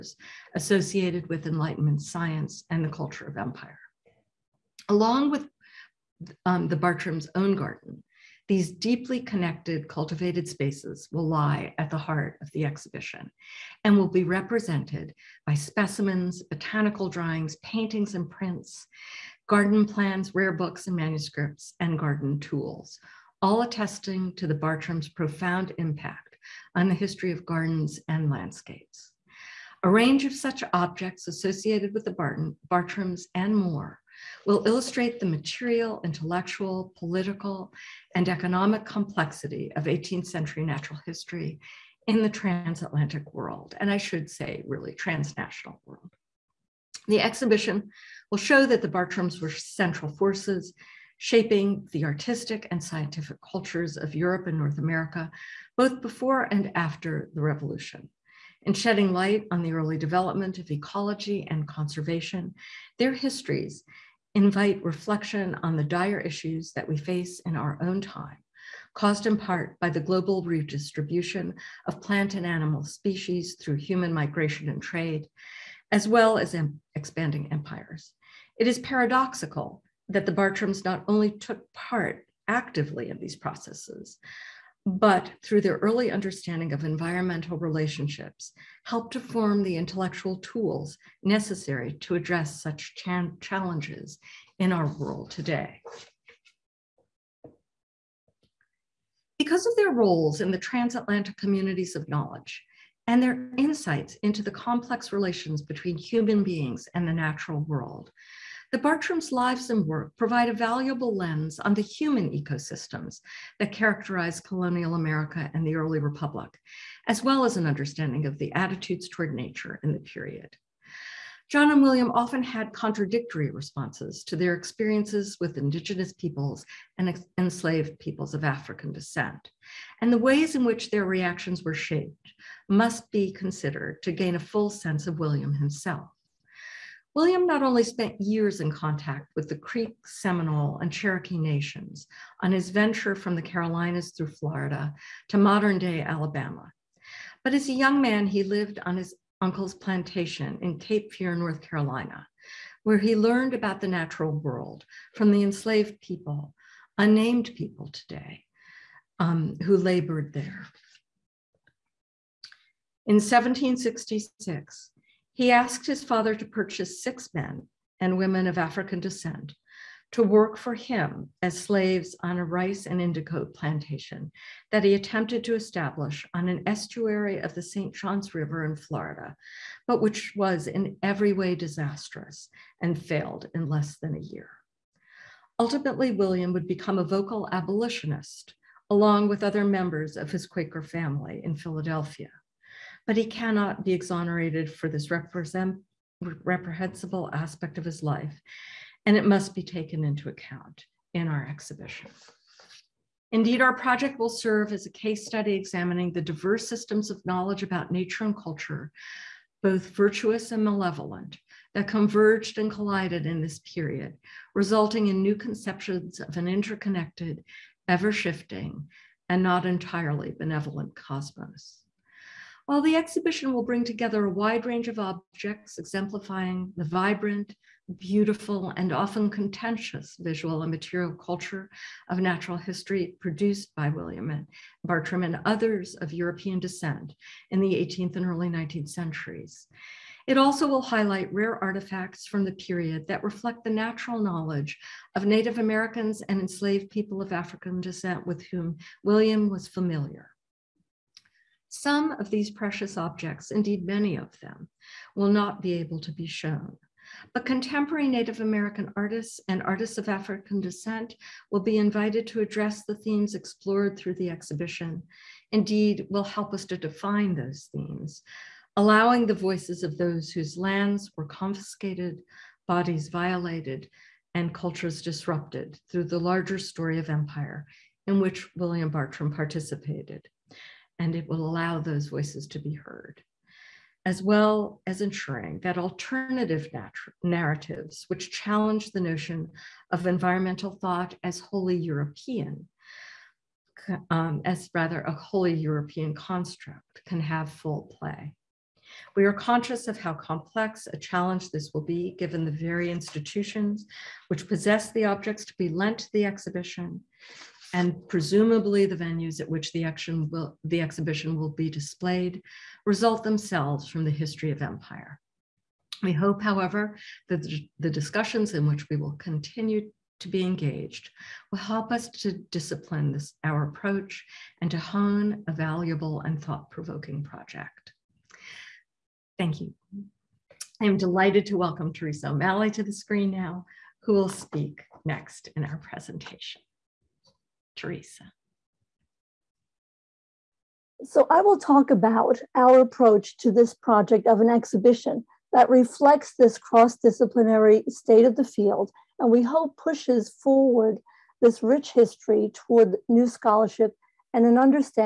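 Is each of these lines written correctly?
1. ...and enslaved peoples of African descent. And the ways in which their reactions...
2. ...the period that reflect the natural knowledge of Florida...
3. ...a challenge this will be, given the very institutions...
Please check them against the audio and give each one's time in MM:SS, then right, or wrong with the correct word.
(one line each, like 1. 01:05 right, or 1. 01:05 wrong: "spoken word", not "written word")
1. 02:06 right
2. 04:02 wrong: "Native", not "Florida"
3. 05:00 right.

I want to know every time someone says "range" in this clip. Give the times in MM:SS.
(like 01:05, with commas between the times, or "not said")
00:29, 03:44.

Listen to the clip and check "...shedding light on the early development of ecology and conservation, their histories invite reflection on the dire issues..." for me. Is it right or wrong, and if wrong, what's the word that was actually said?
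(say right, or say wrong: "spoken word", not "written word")
right.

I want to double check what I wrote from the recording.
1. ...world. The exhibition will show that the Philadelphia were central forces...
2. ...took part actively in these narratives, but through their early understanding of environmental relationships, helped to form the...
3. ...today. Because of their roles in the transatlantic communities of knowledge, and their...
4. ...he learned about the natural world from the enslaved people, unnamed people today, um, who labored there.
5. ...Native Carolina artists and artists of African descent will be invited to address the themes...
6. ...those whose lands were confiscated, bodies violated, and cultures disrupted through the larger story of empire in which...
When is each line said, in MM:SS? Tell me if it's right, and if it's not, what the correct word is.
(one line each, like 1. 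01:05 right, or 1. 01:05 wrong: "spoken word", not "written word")
1. 00:45 wrong: "Bartrams", not "Philadelphia"
2. 01:21 wrong: "processes", not "narratives"
3. 01:35 right
4. 02:32 right
5. 04:18 wrong: "American", not "Carolina"
6. 04:29 right.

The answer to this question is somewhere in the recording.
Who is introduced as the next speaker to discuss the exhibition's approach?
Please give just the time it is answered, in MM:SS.
05:31.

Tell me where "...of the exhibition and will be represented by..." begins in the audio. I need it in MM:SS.
00:12.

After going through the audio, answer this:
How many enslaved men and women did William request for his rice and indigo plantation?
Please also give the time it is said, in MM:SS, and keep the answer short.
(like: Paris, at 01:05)
6, at 02:47.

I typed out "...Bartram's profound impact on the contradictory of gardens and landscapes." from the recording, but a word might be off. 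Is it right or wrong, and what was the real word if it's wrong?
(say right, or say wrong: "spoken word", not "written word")
wrong: "history", not "contradictory".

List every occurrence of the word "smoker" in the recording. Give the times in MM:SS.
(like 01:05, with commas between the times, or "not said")
not said.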